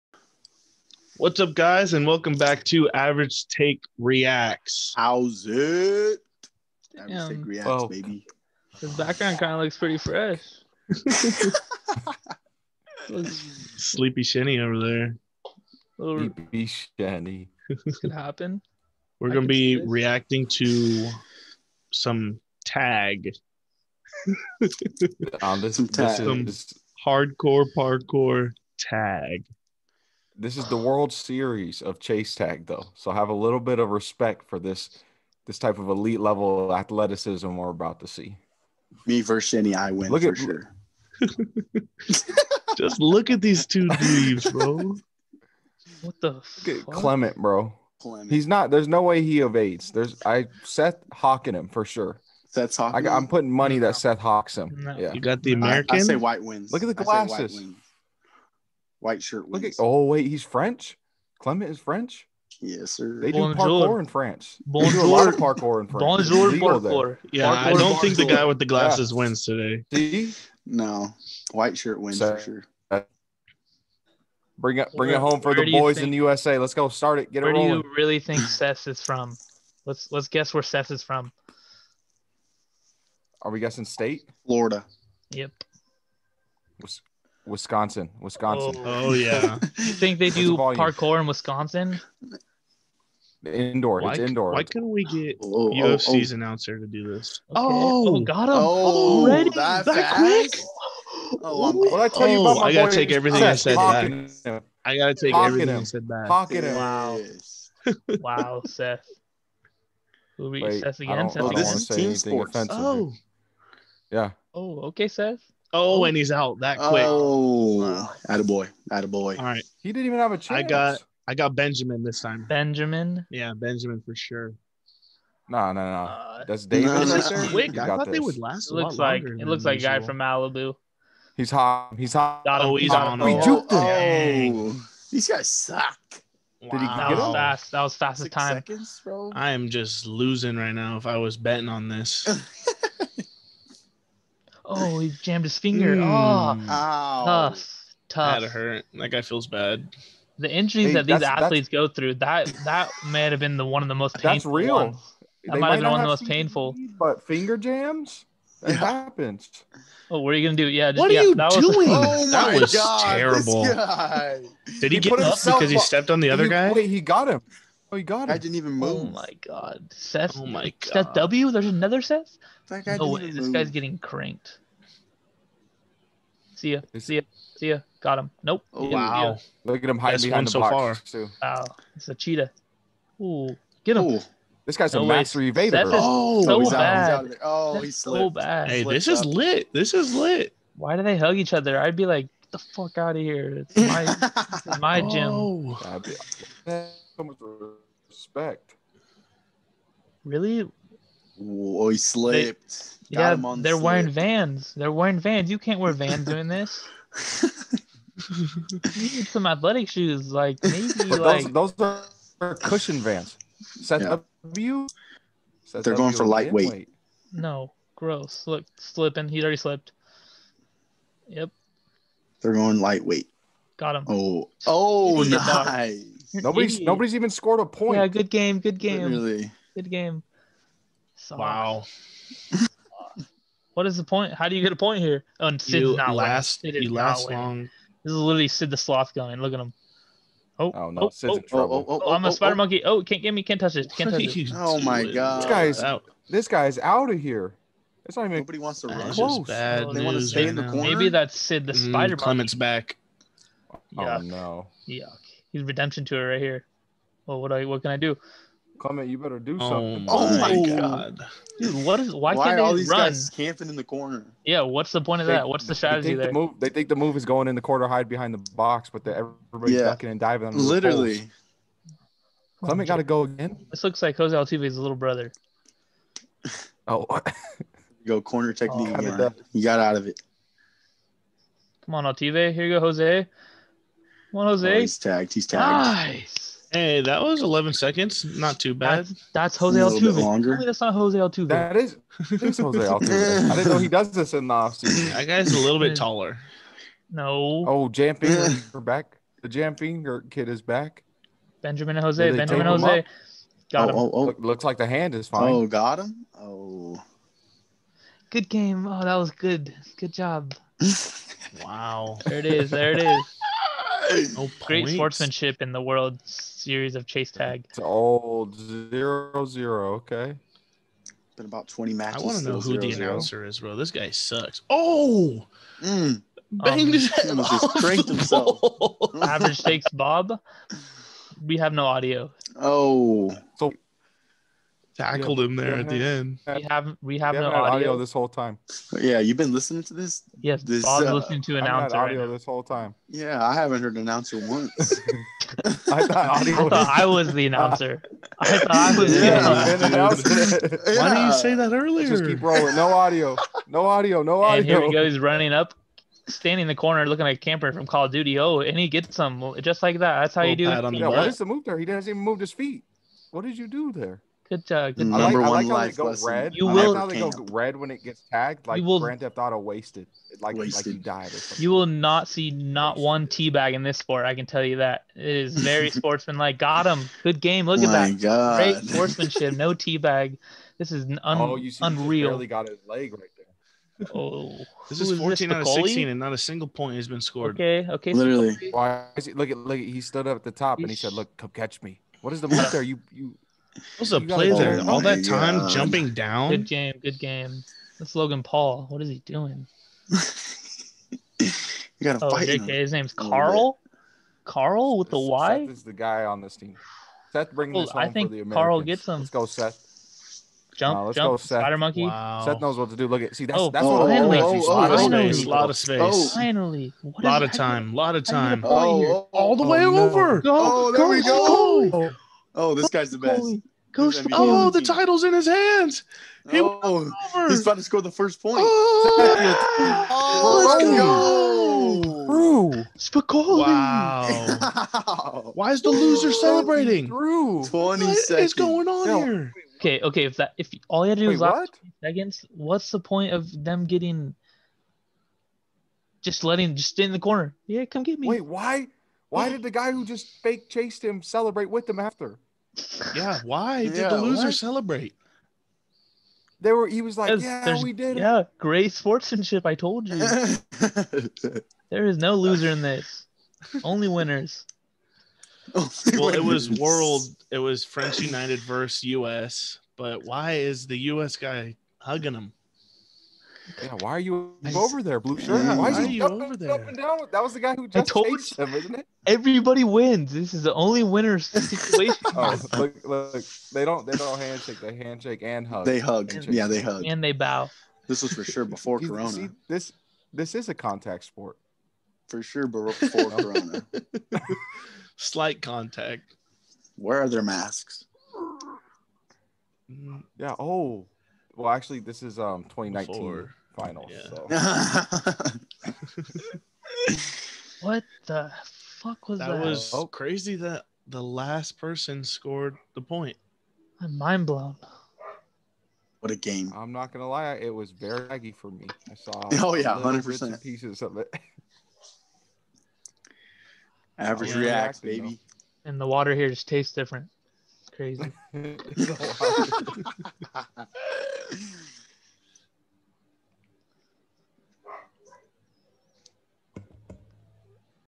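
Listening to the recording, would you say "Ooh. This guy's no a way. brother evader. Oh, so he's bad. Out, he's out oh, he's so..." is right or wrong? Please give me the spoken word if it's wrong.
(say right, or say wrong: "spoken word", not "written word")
wrong: "master", not "brother".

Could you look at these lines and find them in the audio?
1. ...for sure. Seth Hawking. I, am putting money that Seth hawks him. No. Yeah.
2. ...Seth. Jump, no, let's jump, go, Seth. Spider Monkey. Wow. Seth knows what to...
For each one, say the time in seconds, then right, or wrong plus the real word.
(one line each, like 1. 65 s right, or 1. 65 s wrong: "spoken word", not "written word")
1. 51 s right
2. 409 s right.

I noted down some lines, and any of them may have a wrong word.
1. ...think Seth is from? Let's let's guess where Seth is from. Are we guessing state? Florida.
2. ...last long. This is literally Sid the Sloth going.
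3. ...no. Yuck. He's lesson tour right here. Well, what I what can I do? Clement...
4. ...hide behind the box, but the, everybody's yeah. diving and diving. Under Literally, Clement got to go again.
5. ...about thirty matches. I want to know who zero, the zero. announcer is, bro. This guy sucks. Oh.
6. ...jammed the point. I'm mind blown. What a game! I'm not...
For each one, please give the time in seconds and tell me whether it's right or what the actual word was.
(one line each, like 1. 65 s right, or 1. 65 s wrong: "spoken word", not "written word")
1. 78 s right
2. 236 s right
3. 254 s wrong: "redemption", not "lesson"
4. 267 s wrong: "ducking", not "diving"
5. 321 s wrong: "twenty", not "thirty"
6. 512 s wrong: "scored", not "jammed".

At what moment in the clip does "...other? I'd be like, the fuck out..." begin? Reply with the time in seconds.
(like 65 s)
191 s.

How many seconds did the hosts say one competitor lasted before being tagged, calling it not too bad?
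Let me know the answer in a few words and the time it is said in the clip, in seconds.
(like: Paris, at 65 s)
11, at 287 s.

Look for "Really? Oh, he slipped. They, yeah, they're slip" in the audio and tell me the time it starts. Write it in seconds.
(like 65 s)
200 s.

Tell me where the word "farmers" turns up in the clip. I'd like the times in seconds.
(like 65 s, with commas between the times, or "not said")
not said.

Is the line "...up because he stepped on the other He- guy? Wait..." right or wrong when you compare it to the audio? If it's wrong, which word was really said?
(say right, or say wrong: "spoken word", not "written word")
right.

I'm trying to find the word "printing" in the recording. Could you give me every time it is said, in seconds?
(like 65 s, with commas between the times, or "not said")
not said.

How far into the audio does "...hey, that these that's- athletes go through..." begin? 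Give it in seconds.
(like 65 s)
150 s.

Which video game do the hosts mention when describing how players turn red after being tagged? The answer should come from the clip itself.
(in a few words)
Grand Theft Auto.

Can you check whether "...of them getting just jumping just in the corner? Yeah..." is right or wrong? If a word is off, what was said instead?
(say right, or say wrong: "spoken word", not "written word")
wrong: "letting", not "jumping".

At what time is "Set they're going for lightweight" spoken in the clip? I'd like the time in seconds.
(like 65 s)
215 s.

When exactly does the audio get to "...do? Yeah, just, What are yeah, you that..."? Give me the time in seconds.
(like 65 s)
160 s.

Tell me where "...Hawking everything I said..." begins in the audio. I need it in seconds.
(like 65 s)
105 s.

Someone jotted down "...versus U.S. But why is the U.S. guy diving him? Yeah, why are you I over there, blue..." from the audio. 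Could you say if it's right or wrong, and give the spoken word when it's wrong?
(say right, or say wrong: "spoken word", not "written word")
wrong: "hugging", not "diving".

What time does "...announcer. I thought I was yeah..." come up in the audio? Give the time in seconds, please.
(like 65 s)
347 s.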